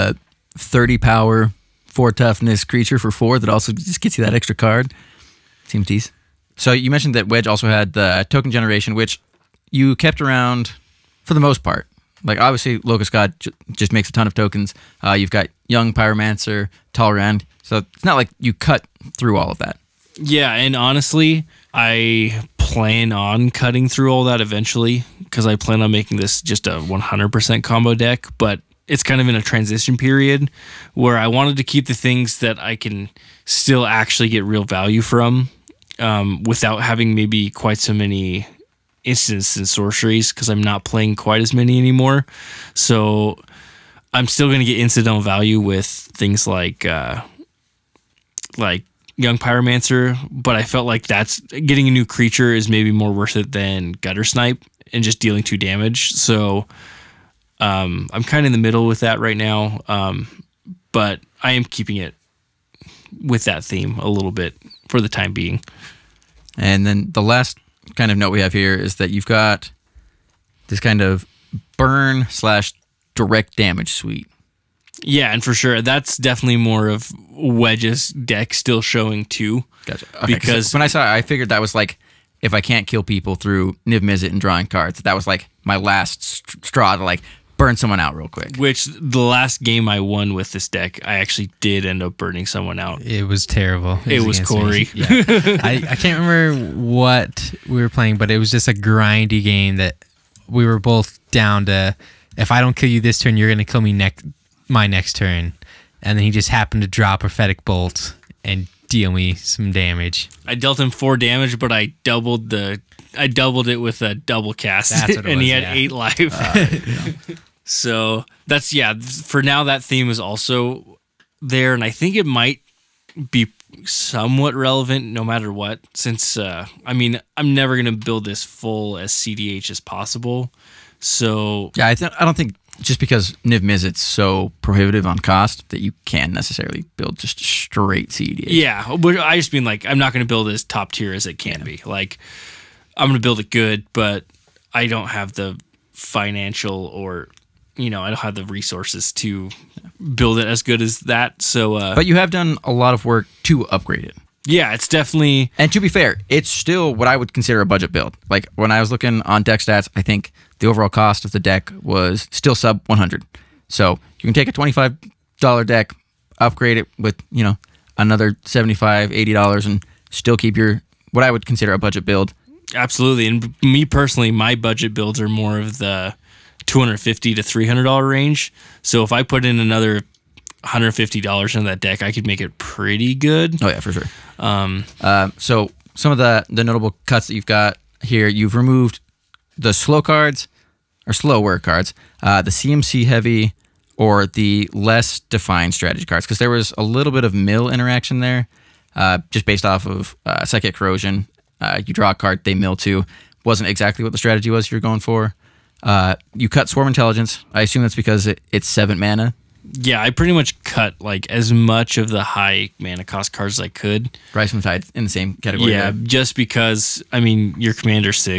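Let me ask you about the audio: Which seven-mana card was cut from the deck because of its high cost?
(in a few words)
Swarm Intelligence.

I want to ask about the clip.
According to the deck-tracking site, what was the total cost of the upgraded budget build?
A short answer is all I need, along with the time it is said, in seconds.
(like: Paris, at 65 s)
sub 100, at 162 s.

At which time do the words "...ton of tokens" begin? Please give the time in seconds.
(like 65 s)
14 s.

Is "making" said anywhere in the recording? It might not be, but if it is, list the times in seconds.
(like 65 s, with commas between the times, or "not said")
25 s.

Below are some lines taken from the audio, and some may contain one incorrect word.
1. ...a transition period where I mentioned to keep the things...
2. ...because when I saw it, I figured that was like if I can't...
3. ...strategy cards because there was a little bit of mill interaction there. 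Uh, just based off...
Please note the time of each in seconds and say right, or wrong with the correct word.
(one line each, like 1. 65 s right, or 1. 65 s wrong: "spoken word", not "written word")
1. 29 s wrong: "wanted", not "mentioned"
2. 80 s right
3. 195 s right.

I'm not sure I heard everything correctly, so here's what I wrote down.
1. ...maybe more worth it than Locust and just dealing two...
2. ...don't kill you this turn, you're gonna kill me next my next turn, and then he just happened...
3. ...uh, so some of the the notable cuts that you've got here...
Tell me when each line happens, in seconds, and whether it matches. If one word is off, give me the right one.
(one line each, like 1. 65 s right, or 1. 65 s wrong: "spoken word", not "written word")
1. 52 s wrong: "Guttersnipe", not "Locust"
2. 102 s right
3. 185 s right.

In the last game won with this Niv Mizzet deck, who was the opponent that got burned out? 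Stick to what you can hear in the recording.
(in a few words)
Cory.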